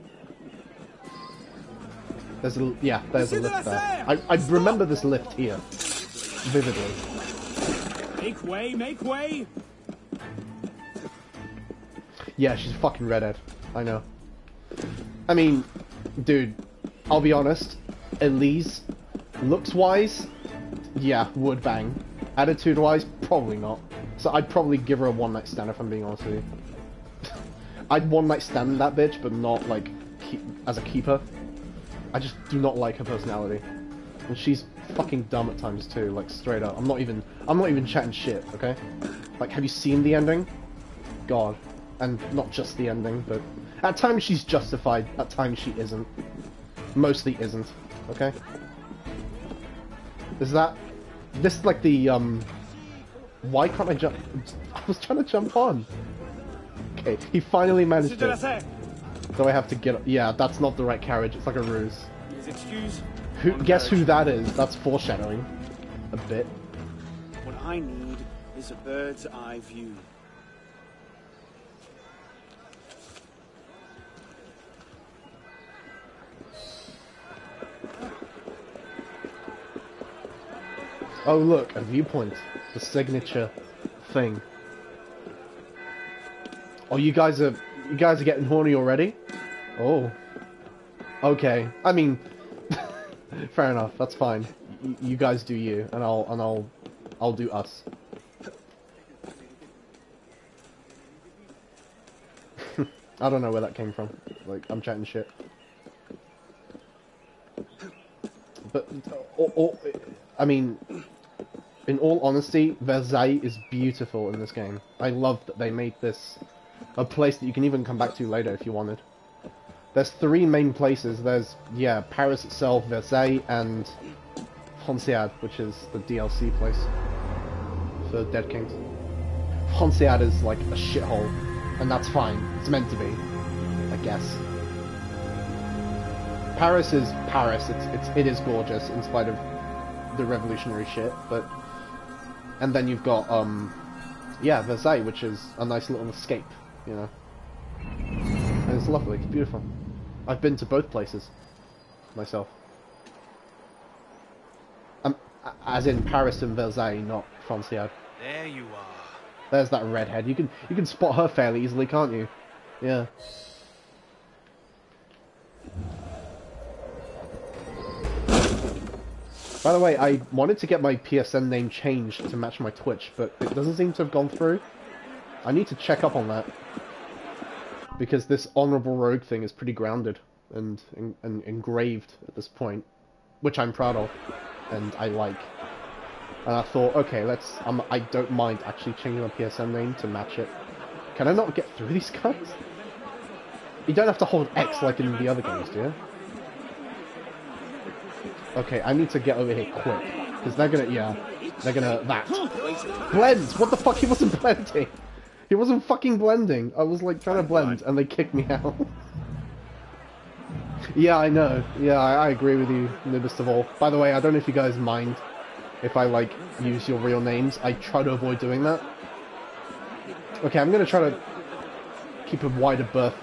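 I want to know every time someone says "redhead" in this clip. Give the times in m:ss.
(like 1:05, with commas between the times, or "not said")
0:13, 2:39.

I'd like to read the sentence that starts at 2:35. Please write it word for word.
Um, as in Paris and Versailles, not Franciade.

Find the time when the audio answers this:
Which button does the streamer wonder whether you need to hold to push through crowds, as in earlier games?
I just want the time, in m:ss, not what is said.
3:14.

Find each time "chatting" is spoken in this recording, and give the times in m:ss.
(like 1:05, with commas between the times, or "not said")
0:37, 1:44.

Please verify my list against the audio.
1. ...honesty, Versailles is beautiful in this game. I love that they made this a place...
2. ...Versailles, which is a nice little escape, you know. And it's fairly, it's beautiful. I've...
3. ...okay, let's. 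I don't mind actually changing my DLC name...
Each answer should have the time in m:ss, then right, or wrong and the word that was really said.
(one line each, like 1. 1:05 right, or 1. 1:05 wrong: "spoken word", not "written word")
1. 1:52 right
2. 2:24 wrong: "lovely", not "fairly"
3. 3:06 wrong: "PSN", not "DLC".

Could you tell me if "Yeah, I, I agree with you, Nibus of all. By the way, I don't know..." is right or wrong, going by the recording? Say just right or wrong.
right.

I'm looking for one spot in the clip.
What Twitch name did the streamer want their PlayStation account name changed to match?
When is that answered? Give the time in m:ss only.
2:58.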